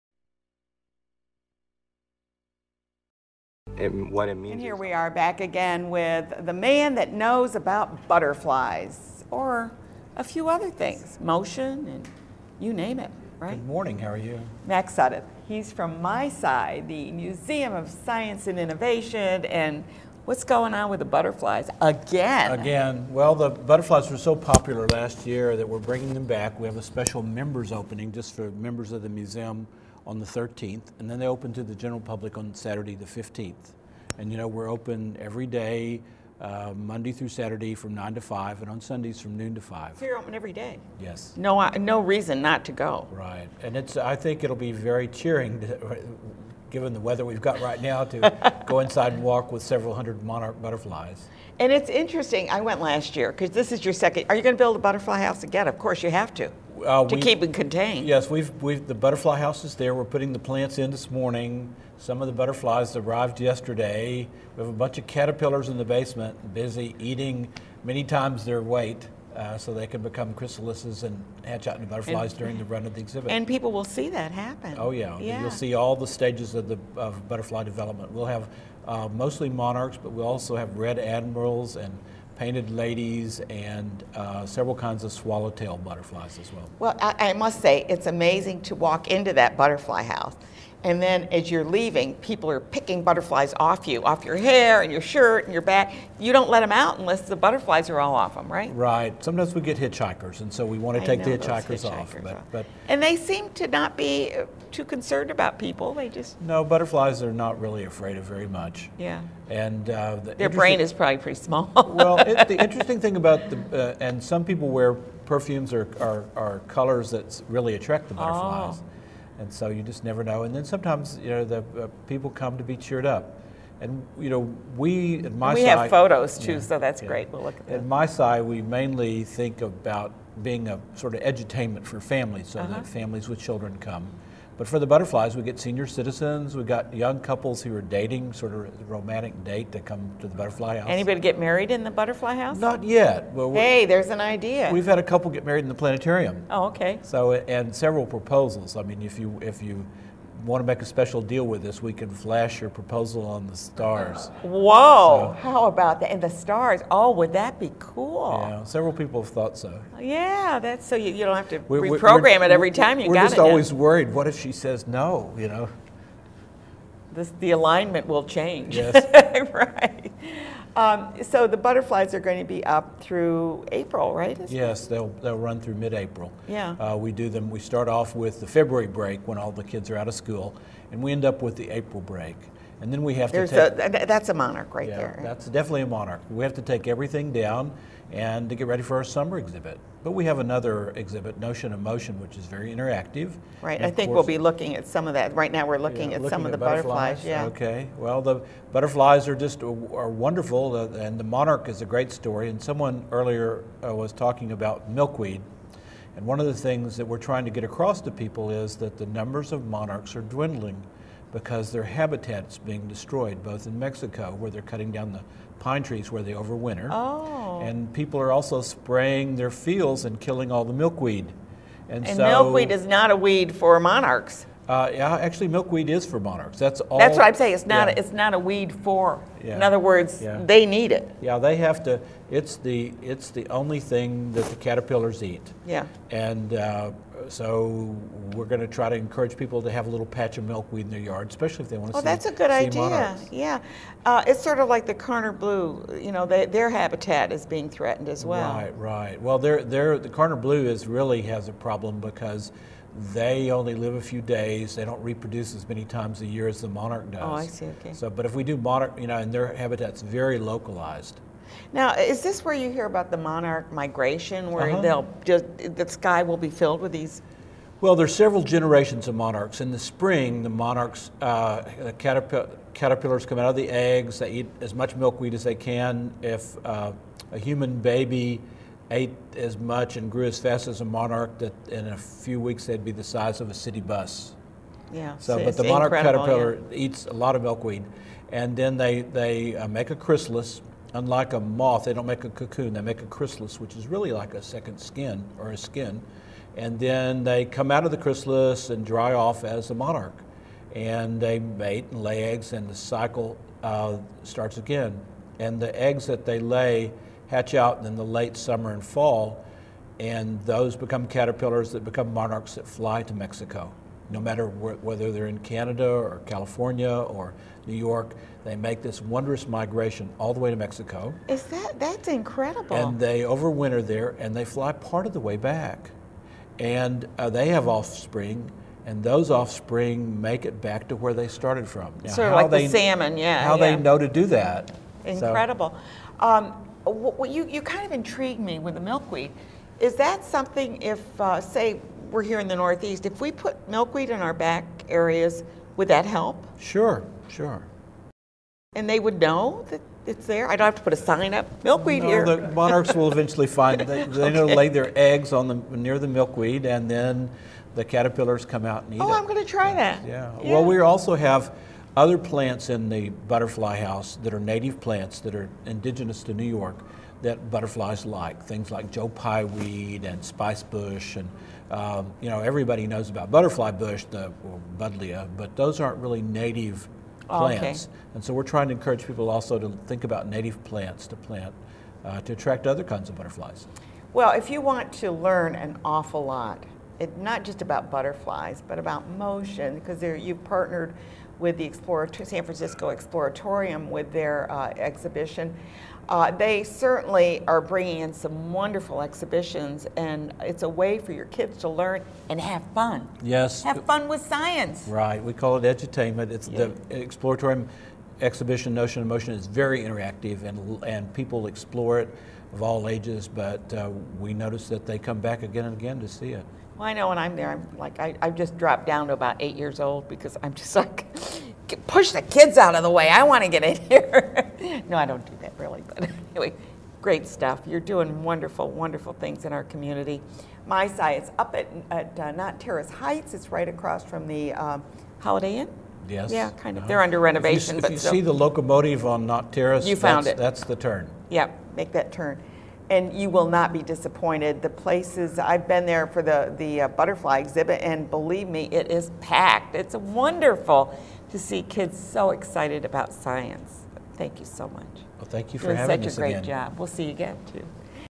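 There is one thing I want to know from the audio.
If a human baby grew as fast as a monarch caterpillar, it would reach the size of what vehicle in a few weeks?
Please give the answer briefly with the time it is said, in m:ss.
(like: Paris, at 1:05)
a city bus, at 4:43.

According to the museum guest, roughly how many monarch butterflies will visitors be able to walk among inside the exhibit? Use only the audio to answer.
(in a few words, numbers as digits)
several hundred.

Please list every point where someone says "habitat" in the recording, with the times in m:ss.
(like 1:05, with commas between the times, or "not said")
3:31, 4:06, 4:19.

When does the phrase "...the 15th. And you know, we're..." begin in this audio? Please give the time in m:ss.
0:32.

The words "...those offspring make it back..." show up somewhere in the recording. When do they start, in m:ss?
5:29.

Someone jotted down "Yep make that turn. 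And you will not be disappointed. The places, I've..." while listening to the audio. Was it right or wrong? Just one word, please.
right.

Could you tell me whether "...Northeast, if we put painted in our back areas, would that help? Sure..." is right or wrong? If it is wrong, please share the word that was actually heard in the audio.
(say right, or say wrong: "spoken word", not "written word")
wrong: "milkweed", not "painted".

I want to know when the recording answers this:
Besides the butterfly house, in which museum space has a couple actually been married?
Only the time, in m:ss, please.
2:25.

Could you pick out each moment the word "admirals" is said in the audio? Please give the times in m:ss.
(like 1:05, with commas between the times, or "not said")
1:20.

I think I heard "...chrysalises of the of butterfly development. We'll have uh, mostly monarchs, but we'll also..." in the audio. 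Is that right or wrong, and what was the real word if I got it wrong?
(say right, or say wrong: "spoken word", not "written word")
wrong: "stages", not "chrysalises".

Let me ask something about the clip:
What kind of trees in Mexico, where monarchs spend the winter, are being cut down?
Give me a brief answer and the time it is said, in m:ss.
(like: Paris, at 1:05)
pine trees, at 3:35.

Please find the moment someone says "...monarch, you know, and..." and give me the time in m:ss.
4:18.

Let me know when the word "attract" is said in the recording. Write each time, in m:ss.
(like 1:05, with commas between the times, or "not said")
1:57, 6:22.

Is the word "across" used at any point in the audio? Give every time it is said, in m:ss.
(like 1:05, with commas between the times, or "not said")
3:27, 7:13.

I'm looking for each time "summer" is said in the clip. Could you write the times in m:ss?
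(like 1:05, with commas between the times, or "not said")
3:09, 5:08.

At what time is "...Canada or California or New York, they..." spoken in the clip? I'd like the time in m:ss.
5:15.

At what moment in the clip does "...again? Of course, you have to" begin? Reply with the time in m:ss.
0:55.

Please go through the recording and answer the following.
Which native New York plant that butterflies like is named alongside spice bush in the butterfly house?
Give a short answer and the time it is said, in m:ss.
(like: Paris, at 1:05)
Joe Pye weed, at 6:08.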